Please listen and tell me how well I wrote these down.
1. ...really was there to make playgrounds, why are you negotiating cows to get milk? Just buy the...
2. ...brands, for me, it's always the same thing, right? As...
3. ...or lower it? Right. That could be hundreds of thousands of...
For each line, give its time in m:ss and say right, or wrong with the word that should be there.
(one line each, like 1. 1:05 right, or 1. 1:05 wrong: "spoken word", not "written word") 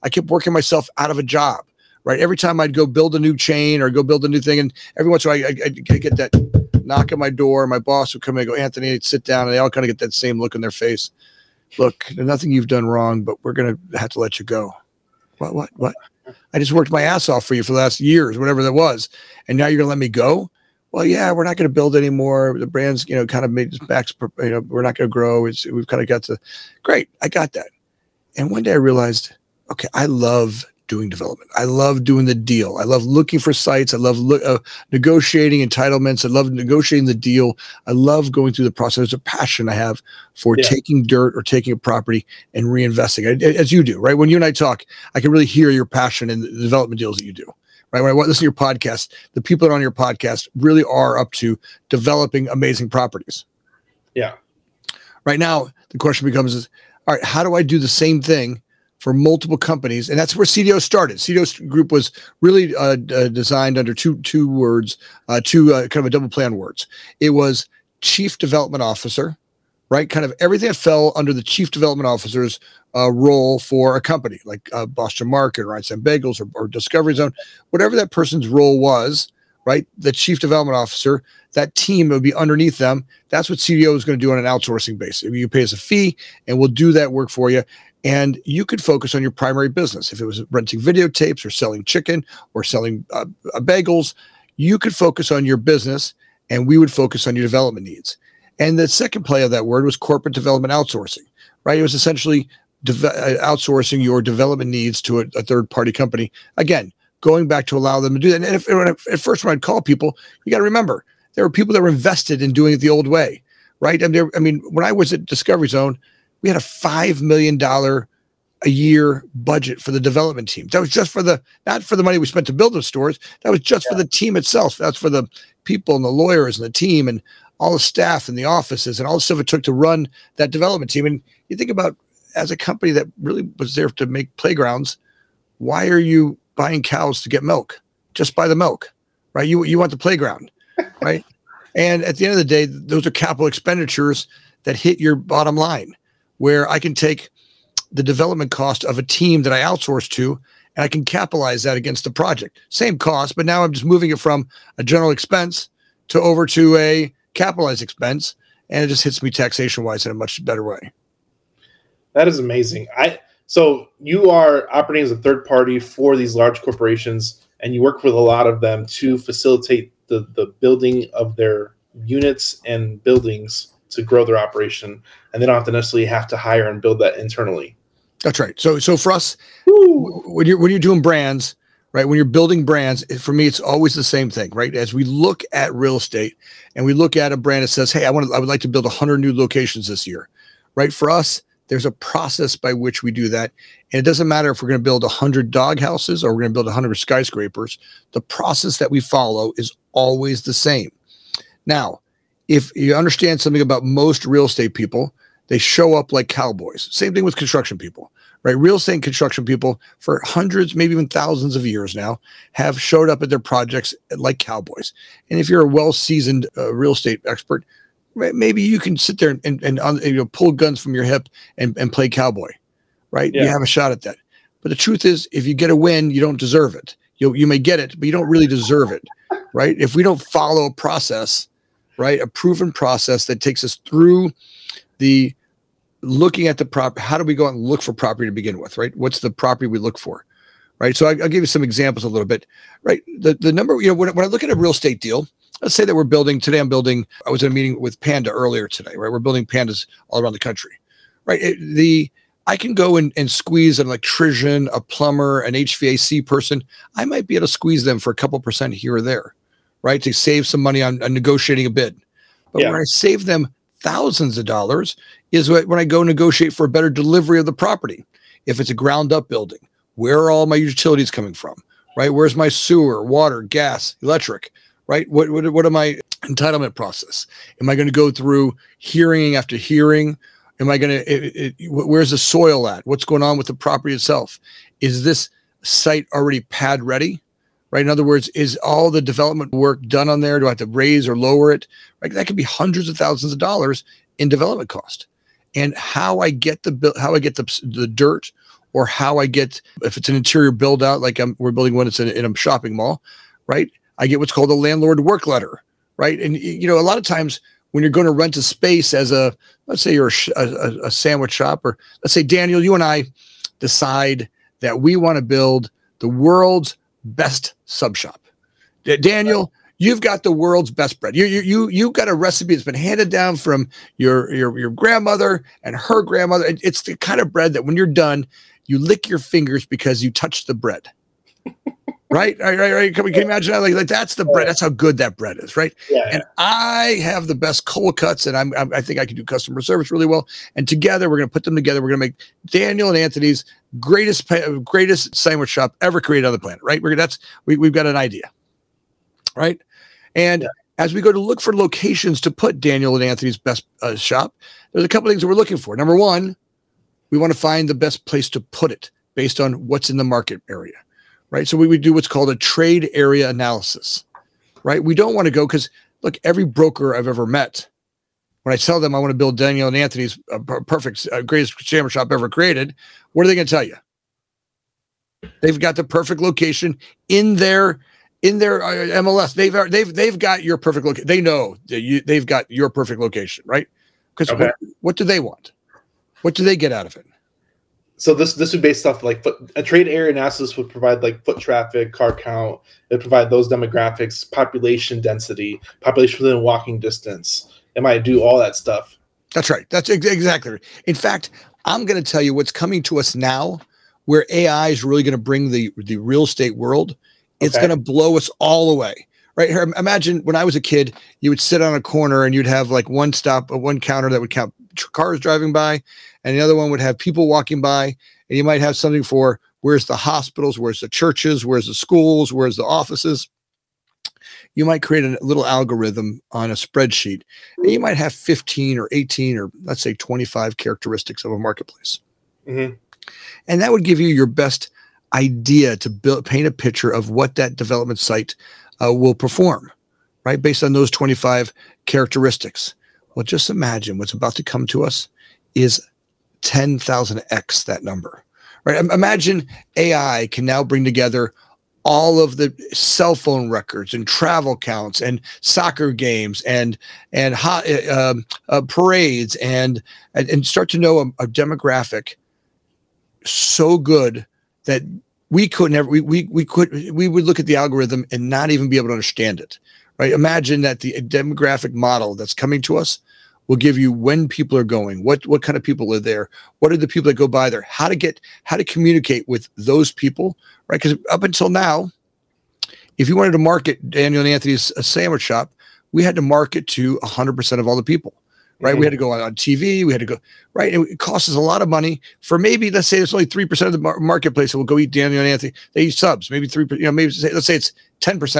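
1. 2:13 wrong: "buying", not "negotiating"
2. 3:02 right
3. 4:51 right.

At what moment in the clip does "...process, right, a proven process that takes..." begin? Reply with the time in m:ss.
3:50.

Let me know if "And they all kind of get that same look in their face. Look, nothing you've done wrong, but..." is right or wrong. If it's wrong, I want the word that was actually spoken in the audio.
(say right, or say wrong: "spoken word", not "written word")
right.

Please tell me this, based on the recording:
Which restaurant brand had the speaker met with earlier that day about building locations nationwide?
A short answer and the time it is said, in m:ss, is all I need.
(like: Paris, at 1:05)
Panda, at 4:08.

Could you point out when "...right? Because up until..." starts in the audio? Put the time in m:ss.
8:00.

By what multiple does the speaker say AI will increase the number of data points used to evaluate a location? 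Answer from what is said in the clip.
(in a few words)
10,000x.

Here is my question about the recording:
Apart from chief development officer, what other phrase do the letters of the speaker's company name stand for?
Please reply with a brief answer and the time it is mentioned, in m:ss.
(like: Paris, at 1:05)
corporate development outsourcing, at 1:39.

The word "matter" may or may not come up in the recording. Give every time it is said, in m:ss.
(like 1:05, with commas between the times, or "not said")
3:14.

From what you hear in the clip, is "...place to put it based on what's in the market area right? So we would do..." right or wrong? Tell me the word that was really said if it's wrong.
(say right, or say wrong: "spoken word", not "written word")
right.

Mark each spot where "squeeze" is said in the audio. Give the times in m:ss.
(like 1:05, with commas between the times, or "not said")
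4:13, 4:17.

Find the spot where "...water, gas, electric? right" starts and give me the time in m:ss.
4:33.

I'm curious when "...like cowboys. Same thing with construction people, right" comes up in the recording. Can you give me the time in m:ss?
3:26.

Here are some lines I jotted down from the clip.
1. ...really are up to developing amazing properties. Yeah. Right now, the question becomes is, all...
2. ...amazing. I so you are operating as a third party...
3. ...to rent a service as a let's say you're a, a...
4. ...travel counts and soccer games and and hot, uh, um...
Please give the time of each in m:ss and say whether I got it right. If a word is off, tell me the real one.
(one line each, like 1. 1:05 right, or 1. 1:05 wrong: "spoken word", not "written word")
1. 0:50 right
2. 2:42 right
3. 5:08 wrong: "space", not "service"
4. 7:34 right.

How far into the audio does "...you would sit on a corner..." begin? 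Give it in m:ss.
6:51.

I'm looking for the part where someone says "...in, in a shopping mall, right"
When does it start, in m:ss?
5:02.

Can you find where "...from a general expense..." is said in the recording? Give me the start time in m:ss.
2:34.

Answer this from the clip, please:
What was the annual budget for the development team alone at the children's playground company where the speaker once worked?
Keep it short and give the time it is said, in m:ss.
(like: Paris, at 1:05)
$5 million, at 1:56.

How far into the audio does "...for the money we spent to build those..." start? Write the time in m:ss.
2:01.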